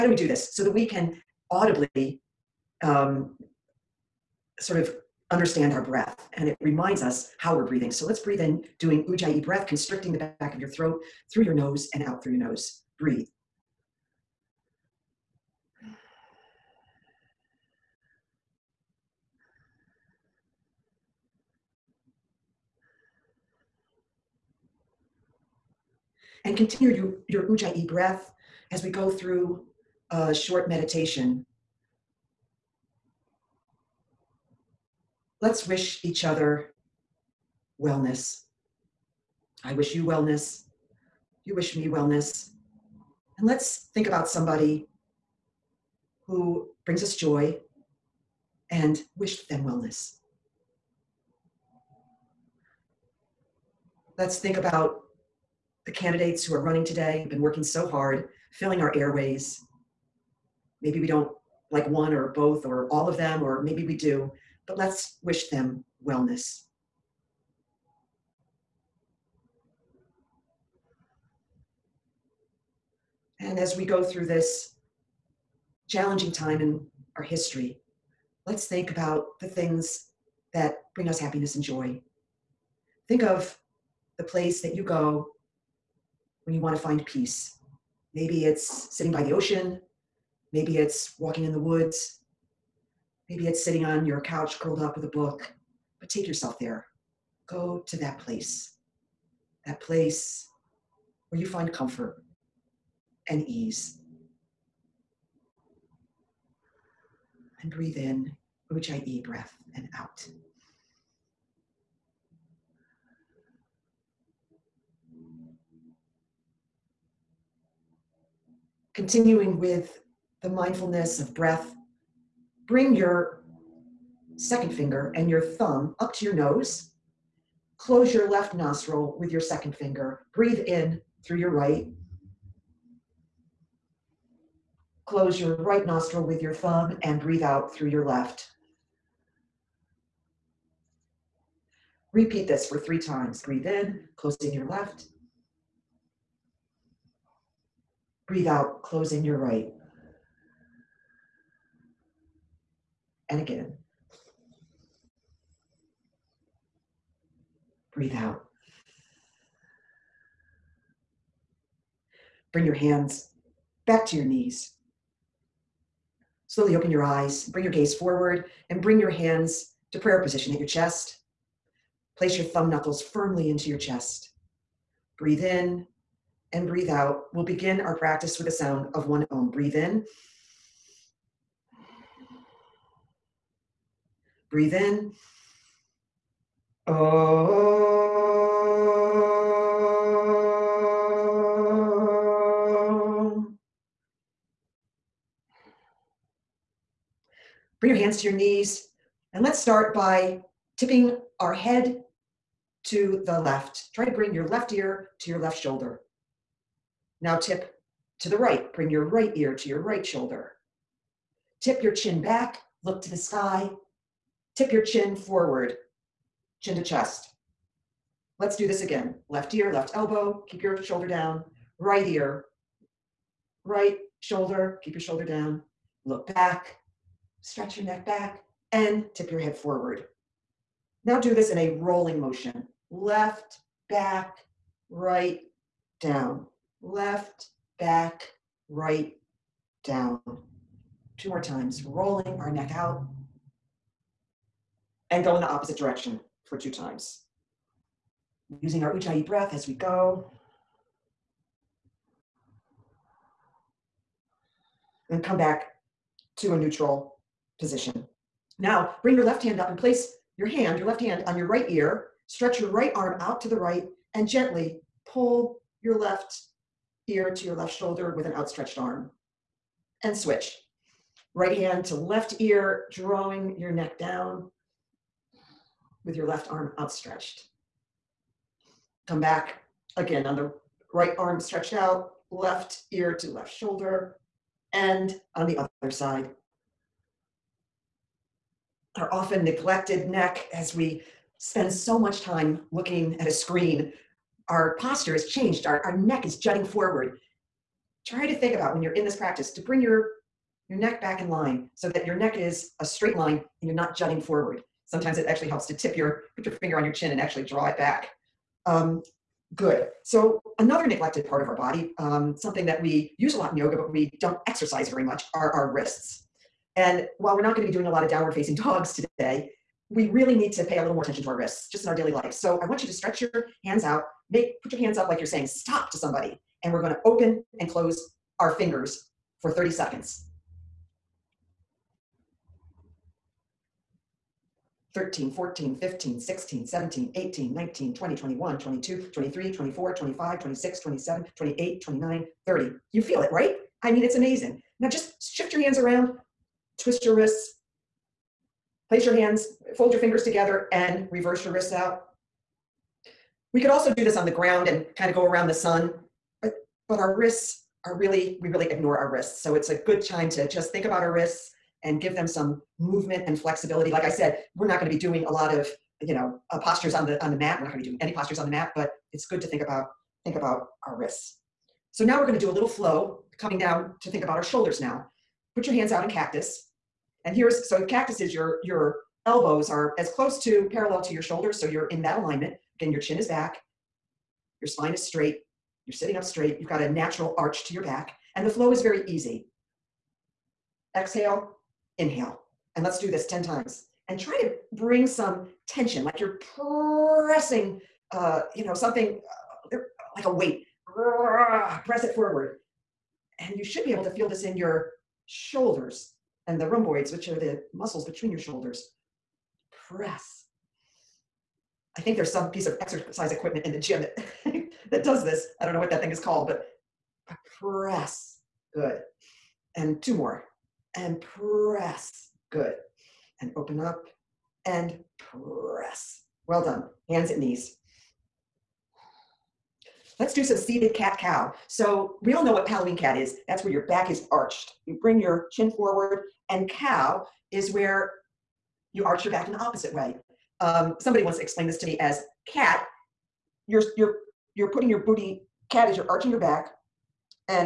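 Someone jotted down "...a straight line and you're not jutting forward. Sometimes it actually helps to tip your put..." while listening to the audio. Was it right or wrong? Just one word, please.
right.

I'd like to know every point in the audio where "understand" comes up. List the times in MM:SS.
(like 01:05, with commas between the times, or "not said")
00:05.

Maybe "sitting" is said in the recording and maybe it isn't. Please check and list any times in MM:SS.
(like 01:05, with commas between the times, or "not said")
01:28, 01:33, 06:25.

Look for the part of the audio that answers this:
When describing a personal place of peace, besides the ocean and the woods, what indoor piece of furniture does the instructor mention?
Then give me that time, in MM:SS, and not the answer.
01:34.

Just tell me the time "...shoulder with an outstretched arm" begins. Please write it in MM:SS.
04:27.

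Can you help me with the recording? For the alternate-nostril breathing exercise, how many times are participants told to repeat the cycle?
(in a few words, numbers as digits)
3.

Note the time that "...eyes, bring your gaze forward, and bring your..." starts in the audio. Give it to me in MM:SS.
02:47.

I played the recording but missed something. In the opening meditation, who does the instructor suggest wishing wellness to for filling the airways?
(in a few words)
the candidates.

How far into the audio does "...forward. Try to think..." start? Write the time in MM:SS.
04:56.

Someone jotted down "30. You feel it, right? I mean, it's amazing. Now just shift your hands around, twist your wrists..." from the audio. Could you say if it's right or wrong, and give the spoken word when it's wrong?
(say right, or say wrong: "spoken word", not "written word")
right.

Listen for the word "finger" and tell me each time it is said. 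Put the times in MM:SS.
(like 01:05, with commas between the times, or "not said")
02:04, 02:09, 05:06, 05:28, 05:49.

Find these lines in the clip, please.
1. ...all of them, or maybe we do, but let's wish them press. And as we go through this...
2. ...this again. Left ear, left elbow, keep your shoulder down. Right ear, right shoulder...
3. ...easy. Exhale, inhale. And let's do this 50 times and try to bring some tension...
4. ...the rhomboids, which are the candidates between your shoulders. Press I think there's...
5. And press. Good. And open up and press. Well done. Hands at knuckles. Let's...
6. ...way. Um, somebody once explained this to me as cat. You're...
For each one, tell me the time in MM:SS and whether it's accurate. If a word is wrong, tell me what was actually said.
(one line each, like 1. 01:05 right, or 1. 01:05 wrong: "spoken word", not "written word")
1. 01:02 wrong: "wellness", not "press"
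2. 03:38 right
3. 06:29 wrong: "10", not "50"
4. 06:46 wrong: "muscles", not "candidates"
5. 07:00 wrong: "knees", not "knuckles"
6. 07:19 right.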